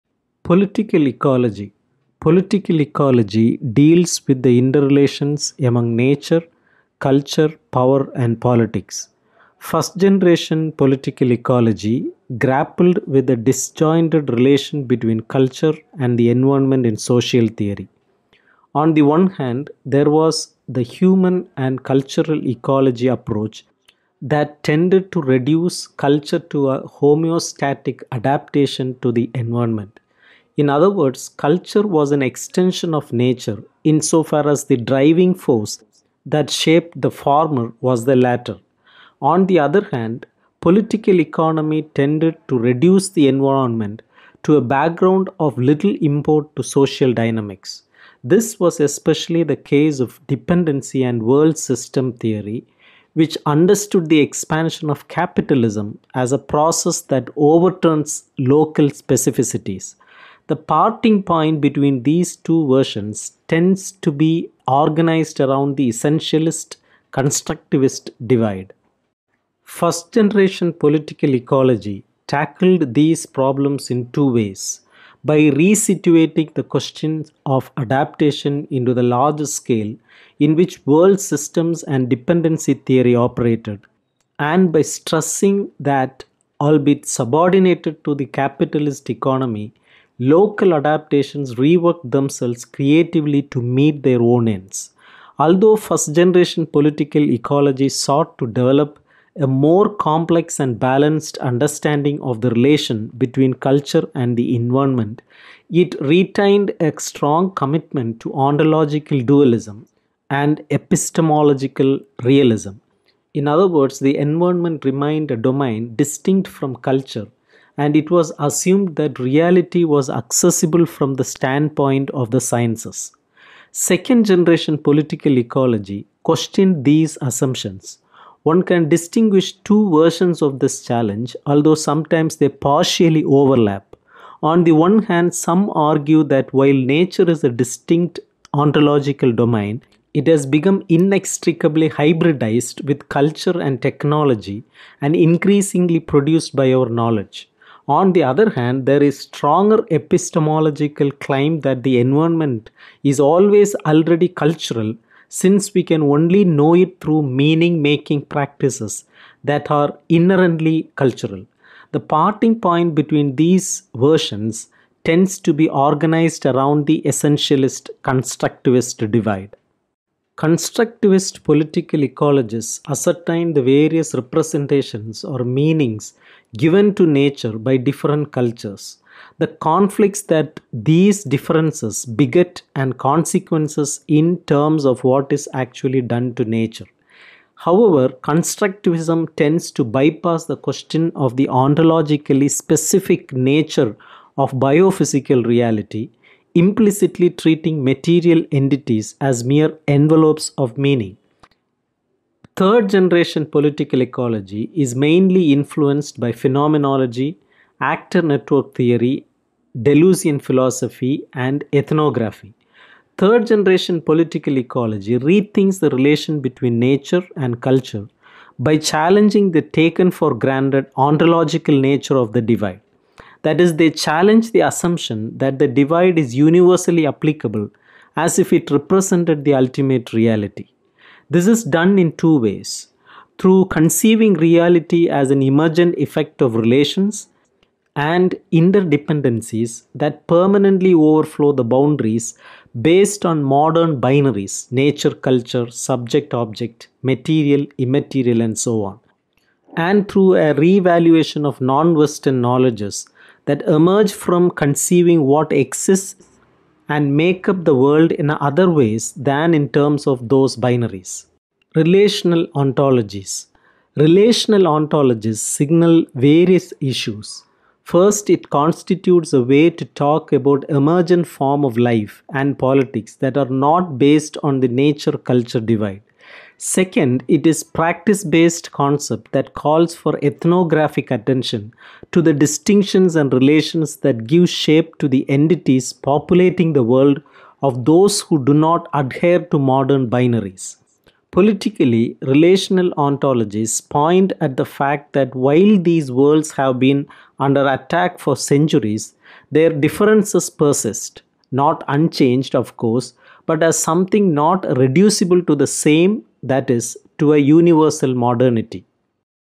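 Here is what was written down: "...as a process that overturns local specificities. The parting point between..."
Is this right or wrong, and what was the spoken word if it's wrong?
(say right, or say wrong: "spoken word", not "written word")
right.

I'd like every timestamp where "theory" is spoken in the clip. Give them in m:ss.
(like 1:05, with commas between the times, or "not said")
0:17, 0:52, 1:22, 3:28.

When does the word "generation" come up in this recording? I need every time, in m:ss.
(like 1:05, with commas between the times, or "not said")
0:10, 1:10, 1:36, 2:04, 3:22, 3:33.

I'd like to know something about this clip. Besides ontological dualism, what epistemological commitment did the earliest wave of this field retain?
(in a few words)
epistemological realism.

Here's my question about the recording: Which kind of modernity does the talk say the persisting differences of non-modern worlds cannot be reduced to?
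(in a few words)
universal modernity.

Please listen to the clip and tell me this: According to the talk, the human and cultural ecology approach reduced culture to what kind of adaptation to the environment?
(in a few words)
homeostatic adaptation.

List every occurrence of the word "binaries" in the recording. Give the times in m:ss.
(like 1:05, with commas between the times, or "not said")
4:03, 4:20, 4:50.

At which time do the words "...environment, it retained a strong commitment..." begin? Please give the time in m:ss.
1:44.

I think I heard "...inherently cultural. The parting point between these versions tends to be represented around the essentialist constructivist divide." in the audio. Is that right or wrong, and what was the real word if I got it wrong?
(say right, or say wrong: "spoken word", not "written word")
wrong: "organized", not "represented".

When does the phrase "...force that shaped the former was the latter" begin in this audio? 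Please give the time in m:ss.
0:35.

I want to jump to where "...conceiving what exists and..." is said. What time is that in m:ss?
4:14.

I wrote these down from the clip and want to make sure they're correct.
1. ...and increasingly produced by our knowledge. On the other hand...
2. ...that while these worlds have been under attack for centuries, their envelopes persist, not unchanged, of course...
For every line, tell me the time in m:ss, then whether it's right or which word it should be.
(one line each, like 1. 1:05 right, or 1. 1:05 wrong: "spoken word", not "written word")
1. 2:24 right
2. 4:55 wrong: "differences", not "envelopes".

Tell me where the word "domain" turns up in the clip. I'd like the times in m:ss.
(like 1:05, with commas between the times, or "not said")
1:55, 2:19.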